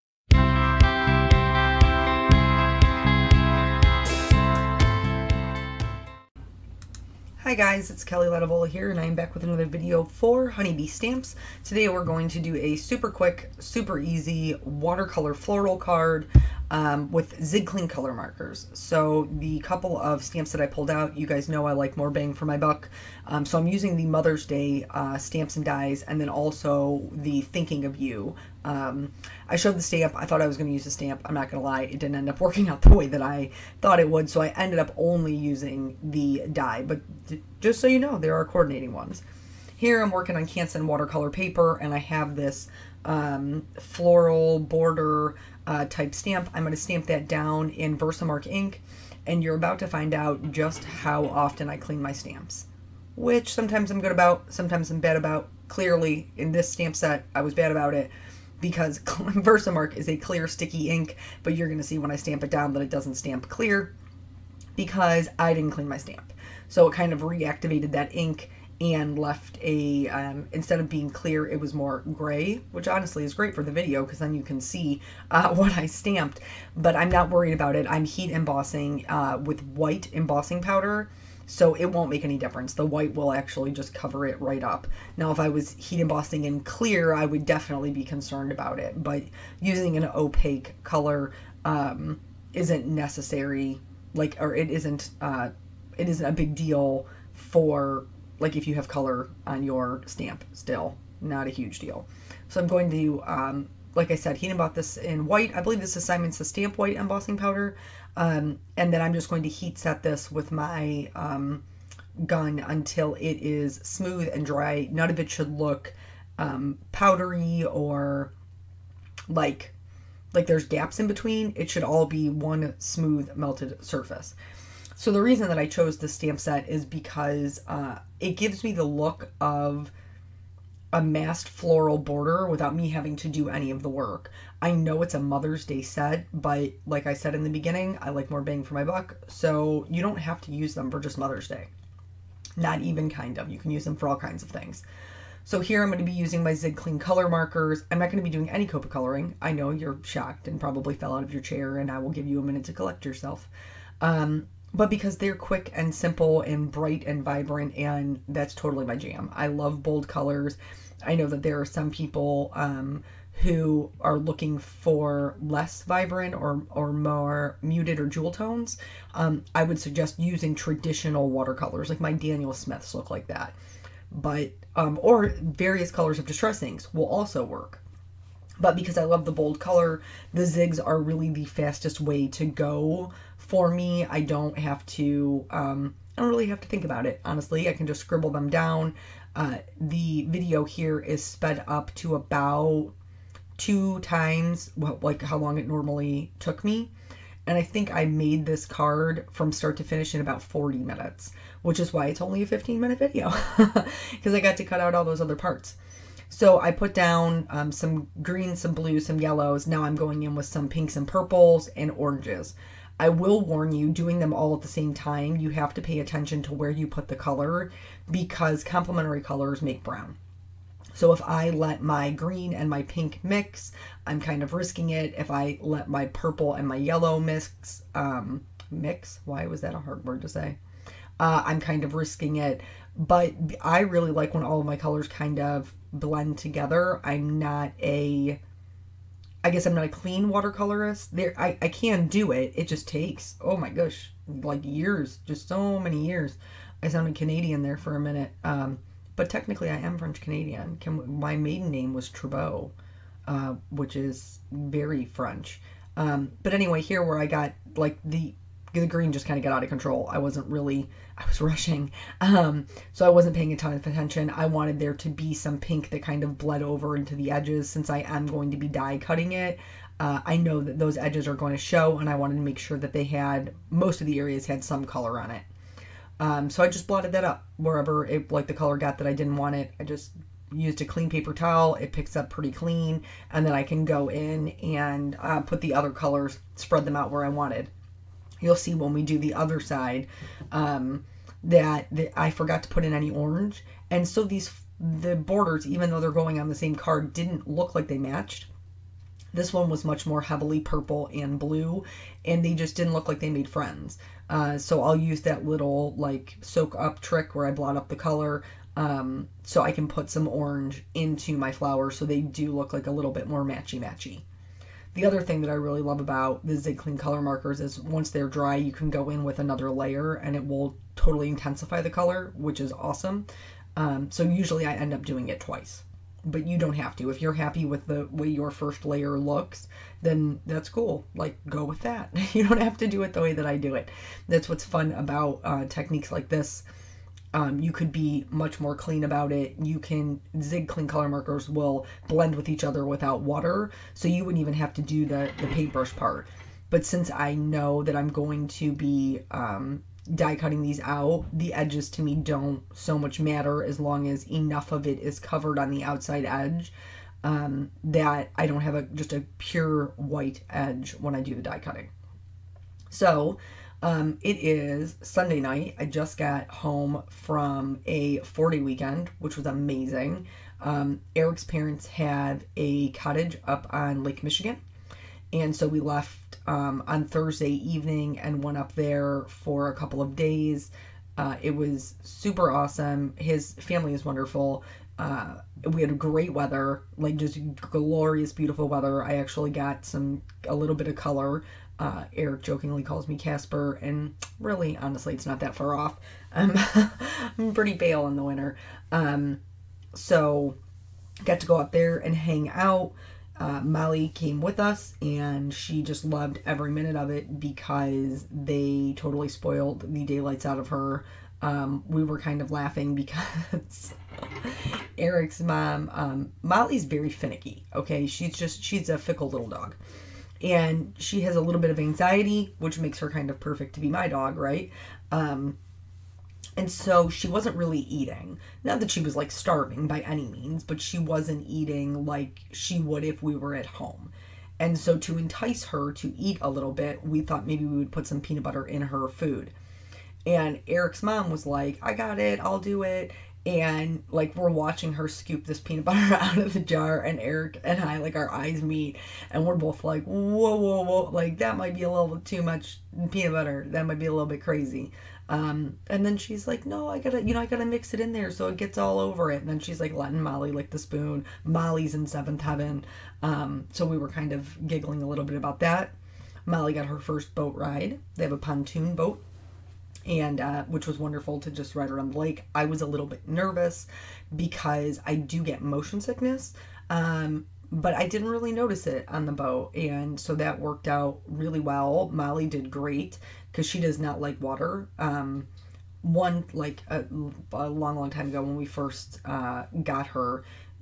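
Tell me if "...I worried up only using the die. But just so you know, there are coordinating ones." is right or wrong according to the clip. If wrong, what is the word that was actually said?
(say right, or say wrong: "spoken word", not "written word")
wrong: "ended", not "worried".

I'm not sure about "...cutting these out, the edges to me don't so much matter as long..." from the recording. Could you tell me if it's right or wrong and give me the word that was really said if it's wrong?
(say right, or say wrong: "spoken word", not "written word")
right.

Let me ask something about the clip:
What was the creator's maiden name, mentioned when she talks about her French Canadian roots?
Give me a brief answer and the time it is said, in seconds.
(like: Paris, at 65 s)
Trebot, at 252 s.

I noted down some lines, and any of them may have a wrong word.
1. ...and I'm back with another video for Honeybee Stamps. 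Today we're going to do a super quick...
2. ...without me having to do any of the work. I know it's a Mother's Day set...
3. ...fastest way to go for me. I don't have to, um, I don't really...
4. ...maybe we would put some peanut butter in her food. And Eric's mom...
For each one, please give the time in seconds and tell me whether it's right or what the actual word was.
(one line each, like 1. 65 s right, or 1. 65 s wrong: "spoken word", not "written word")
1. 8 s right
2. 132 s right
3. 181 s right
4. 437 s right.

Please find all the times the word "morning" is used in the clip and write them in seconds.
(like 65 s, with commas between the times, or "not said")
not said.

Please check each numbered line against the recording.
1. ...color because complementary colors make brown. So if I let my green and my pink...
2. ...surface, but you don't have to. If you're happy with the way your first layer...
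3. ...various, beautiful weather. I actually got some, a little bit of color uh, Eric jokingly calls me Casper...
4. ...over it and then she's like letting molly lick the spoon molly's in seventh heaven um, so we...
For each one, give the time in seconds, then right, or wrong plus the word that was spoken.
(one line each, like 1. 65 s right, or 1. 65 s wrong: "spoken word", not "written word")
1. 217 s right
2. 325 s wrong: "twice", not "surface"
3. 387 s wrong: "glorious", not "various"
4. 458 s right.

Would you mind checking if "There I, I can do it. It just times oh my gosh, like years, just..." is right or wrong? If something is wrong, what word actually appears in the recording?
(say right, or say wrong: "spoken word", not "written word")
wrong: "takes", not "times".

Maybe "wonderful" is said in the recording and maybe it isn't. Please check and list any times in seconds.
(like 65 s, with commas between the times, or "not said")
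384 s, 470 s.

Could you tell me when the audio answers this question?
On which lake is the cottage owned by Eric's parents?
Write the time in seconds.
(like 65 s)
374 s.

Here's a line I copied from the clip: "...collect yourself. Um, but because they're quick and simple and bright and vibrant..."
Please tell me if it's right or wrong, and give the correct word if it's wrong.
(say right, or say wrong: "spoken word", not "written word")
right.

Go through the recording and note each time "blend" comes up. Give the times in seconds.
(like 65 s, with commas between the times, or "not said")
235 s, 342 s.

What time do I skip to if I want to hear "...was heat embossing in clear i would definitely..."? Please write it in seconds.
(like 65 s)
85 s.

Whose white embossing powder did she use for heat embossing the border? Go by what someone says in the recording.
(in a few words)
Simon's Stamp.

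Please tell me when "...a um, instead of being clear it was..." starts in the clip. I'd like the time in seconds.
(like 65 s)
69 s.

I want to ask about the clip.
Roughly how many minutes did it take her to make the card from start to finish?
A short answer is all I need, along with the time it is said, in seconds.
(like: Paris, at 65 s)
40 minutes, at 200 s.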